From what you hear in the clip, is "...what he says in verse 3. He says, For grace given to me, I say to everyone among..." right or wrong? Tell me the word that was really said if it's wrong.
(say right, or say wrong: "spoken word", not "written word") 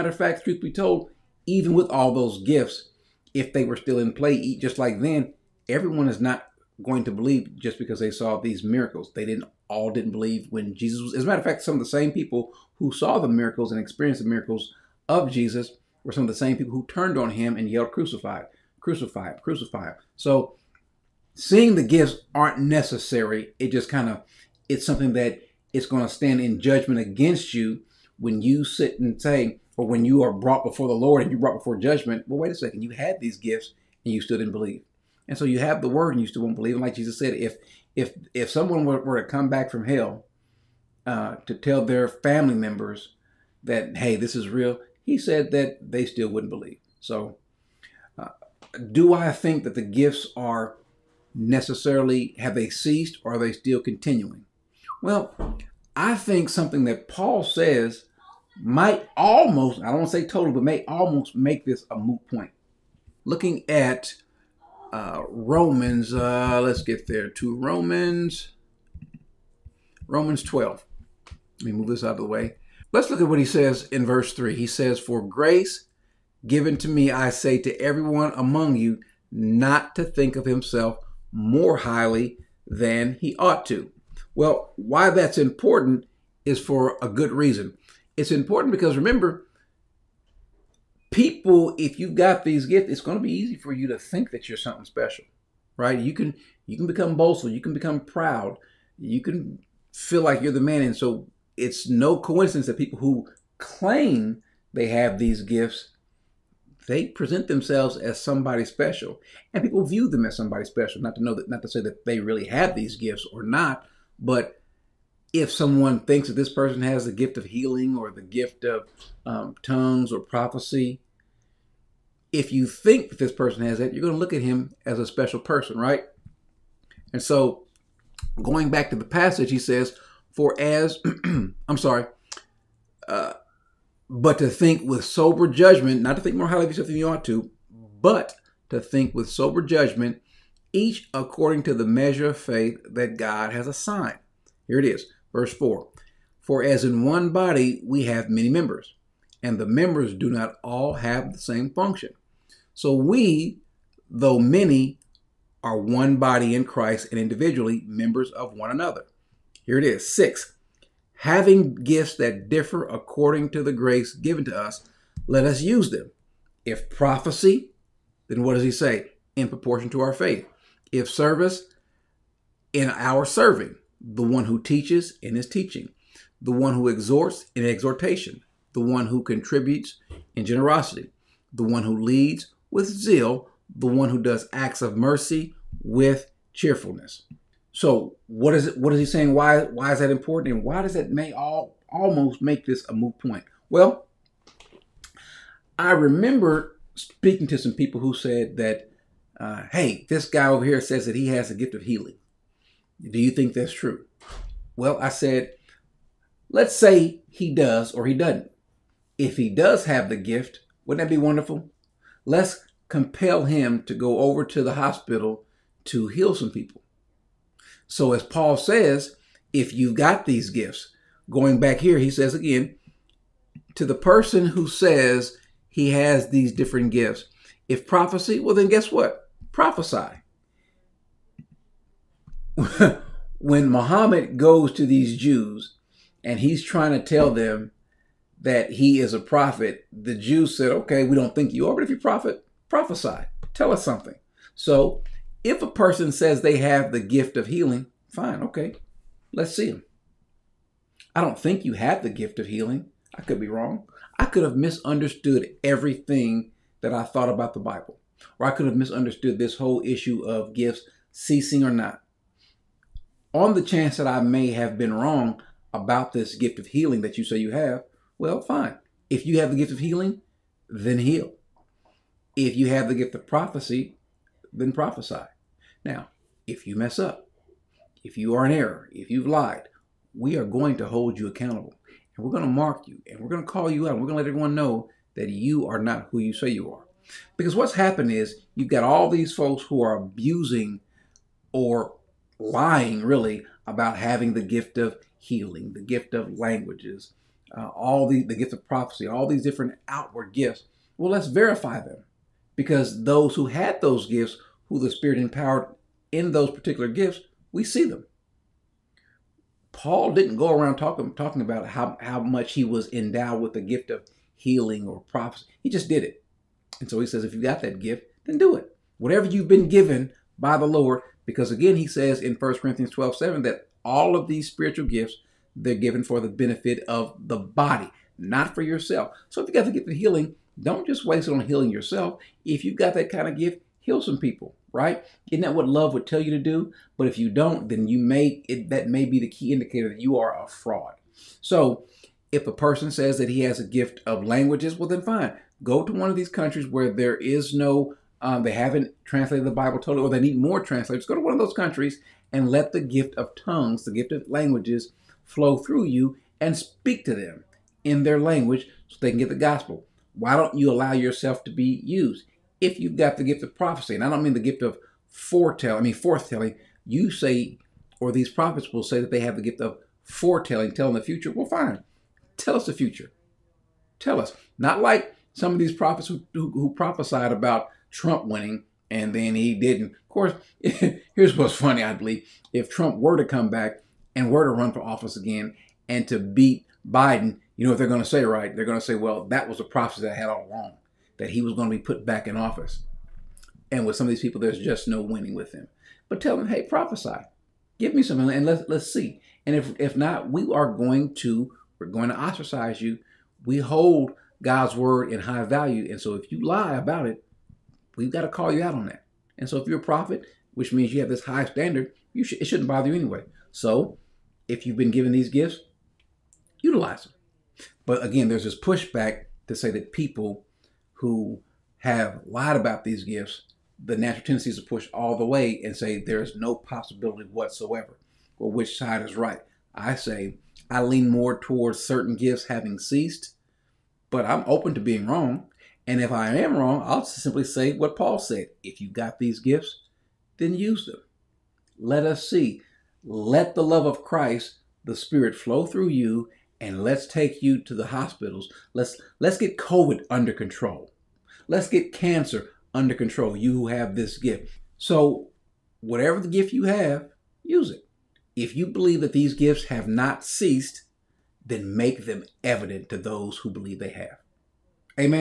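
right.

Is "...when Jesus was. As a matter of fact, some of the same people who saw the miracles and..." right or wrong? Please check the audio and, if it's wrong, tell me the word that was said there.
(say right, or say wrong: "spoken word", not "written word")
right.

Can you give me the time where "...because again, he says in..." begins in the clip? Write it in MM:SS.
05:21.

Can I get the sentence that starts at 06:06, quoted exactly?
you say, or these prophets will say that they have the gift of foretelling, telling the future.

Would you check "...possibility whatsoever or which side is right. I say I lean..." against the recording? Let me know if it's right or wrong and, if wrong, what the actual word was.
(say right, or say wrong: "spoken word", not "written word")
right.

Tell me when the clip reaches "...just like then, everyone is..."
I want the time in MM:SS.
00:04.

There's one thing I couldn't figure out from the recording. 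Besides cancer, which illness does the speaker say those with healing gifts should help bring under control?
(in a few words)
COVID.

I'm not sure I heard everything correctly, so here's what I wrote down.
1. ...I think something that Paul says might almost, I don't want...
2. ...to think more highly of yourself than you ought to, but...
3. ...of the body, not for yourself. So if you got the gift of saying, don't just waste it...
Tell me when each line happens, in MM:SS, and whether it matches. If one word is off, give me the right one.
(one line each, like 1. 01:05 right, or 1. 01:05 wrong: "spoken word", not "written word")
1. 00:55 right
2. 02:16 right
3. 05:26 wrong: "healing", not "saying".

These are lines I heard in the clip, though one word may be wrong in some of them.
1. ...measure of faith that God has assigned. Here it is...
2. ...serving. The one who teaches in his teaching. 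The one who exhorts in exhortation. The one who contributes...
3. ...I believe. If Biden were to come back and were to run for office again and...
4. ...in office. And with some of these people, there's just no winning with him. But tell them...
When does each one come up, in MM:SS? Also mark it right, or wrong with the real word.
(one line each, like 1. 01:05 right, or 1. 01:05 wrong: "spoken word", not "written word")
1. 02:21 right
2. 02:53 right
3. 06:21 wrong: "Trump", not "Biden"
4. 06:32 right.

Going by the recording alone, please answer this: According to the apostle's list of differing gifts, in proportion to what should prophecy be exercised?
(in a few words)
Our faith.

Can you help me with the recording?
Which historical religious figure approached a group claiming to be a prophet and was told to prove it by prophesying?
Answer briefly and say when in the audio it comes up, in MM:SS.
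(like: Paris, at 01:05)
Muhammad, at 03:53.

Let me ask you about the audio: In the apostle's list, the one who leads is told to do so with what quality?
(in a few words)
Zeal.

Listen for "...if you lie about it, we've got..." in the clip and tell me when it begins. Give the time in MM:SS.
06:46.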